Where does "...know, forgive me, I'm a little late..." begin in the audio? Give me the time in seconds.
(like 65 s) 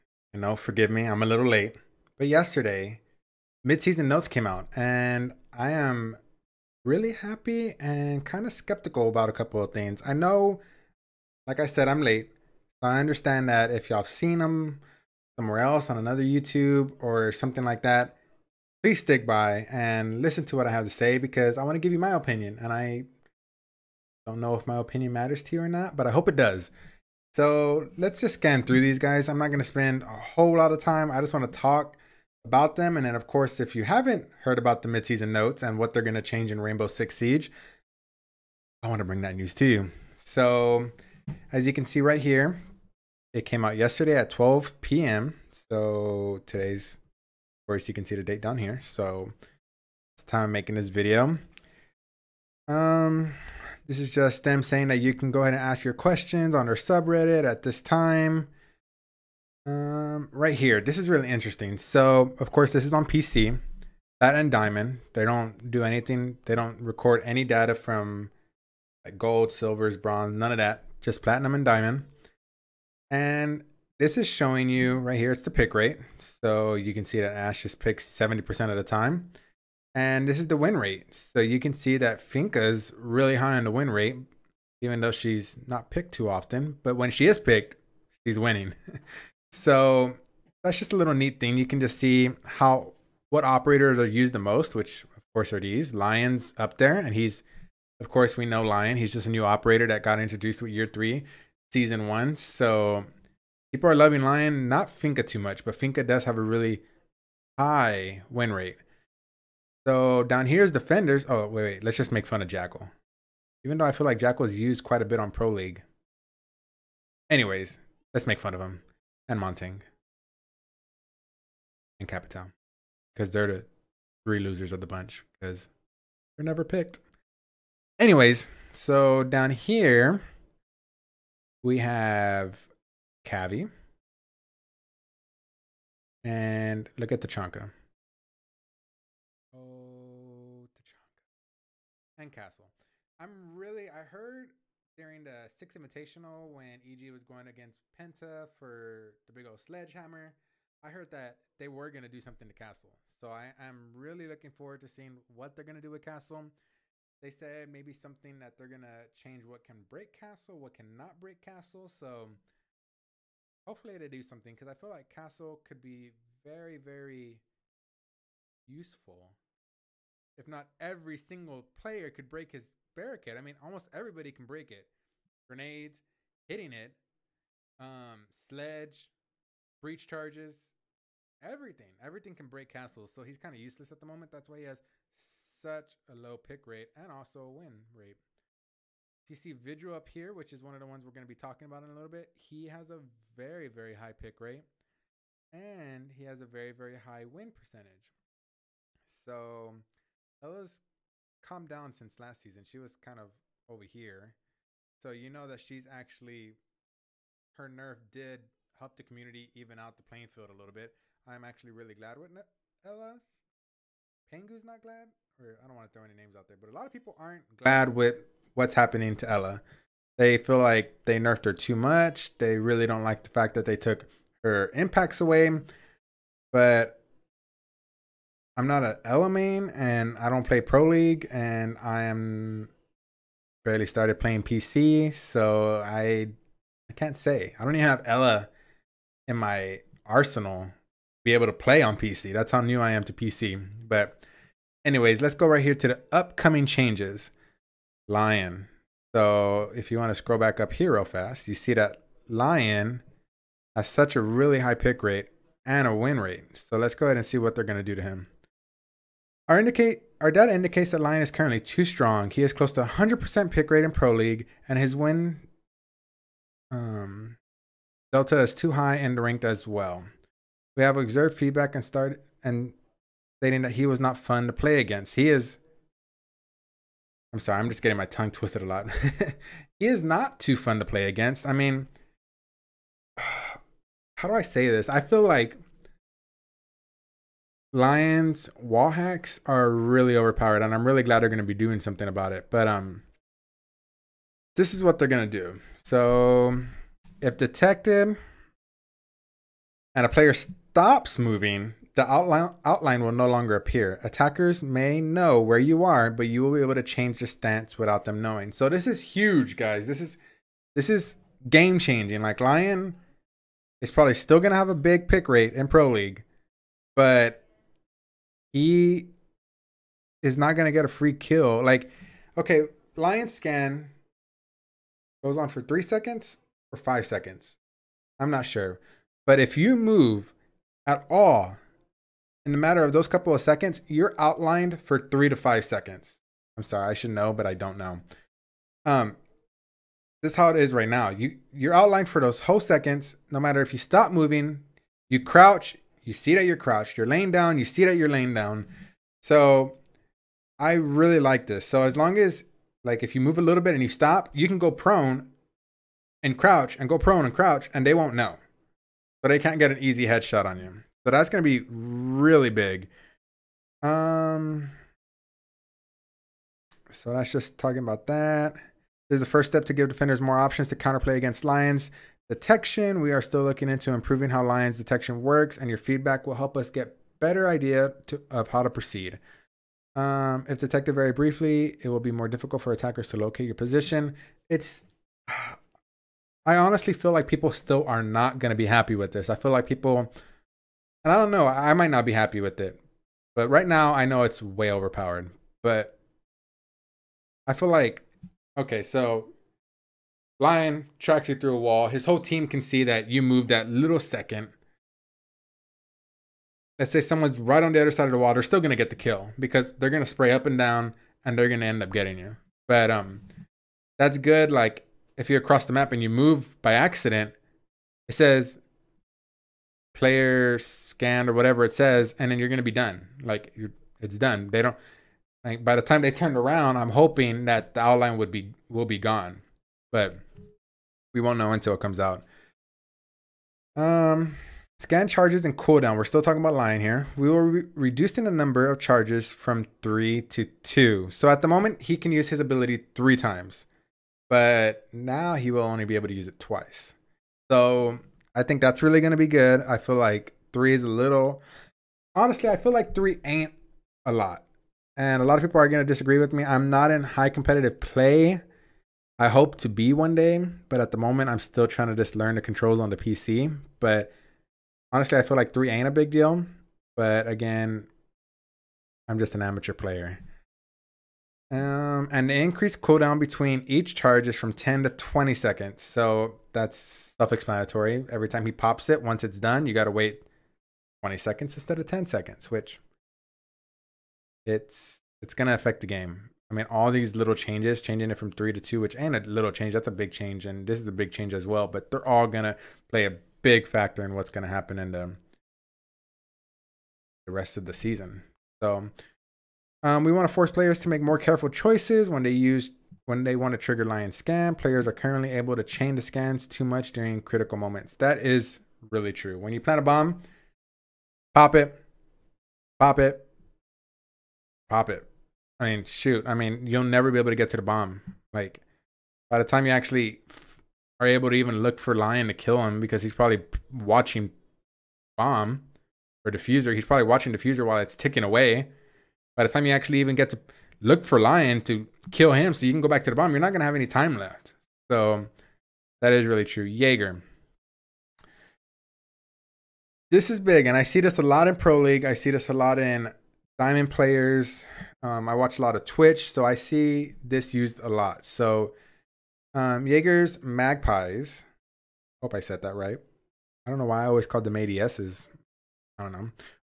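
0 s.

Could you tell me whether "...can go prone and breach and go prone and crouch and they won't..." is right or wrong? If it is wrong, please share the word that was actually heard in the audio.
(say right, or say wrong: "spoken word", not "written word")
wrong: "crouch", not "breach".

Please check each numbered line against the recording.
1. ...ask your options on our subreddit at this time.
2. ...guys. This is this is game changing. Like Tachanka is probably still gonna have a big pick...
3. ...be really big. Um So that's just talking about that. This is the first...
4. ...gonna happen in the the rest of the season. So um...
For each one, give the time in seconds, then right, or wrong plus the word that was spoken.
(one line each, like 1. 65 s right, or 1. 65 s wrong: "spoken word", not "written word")
1. 55 s wrong: "questions", not "options"
2. 309 s wrong: "Lion", not "Tachanka"
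3. 361 s right
4. 494 s right.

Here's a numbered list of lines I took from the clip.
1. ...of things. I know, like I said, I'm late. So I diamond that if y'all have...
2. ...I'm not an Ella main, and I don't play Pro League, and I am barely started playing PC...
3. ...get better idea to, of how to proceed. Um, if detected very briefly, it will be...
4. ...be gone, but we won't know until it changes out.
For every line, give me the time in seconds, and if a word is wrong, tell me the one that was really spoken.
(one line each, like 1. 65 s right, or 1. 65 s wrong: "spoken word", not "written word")
1. 9 s wrong: "understand", not "diamond"
2. 228 s right
3. 376 s right
4. 428 s wrong: "comes", not "changes".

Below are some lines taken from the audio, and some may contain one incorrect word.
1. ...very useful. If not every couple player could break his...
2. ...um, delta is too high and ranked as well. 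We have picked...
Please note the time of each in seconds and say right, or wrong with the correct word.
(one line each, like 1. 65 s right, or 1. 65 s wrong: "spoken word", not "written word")
1. 166 s wrong: "single", not "couple"
2. 266 s wrong: "observed", not "picked".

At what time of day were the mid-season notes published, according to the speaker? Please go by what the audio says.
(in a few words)
12 p.m.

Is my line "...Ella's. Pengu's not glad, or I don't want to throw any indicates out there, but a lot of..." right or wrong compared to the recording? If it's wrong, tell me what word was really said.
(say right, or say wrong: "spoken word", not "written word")
wrong: "names", not "indicates".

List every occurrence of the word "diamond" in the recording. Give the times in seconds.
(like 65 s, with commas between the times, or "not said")
64 s, 71 s, 543 s.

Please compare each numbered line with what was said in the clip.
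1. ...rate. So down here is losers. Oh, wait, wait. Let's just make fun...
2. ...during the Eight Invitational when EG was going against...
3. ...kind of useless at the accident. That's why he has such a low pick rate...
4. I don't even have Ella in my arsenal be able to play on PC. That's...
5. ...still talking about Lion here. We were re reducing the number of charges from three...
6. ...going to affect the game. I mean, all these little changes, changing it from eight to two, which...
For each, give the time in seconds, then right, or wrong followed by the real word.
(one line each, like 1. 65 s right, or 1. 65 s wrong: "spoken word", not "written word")
1. 108 s wrong: "defenders", not "losers"
2. 144 s wrong: "Six", not "Eight"
3. 183 s wrong: "moment", not "accident"
4. 237 s right
5. 436 s right
6. 485 s wrong: "three", not "eight".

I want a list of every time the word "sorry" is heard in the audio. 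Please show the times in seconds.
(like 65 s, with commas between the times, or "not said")
277 s, 336 s.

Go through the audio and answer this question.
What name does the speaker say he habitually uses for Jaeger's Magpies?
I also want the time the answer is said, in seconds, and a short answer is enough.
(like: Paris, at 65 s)
ADSs, at 554 s.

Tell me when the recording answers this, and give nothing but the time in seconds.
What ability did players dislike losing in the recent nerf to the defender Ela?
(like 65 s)
224 s.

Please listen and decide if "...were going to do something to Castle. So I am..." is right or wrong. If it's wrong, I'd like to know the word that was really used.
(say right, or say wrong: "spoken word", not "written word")
right.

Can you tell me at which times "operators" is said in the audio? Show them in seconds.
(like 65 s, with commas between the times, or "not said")
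93 s, 99 s.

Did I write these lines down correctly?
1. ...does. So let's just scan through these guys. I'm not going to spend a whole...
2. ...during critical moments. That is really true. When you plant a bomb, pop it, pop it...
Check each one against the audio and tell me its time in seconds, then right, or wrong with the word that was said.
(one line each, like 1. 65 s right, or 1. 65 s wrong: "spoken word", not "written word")
1. 26 s right
2. 506 s right.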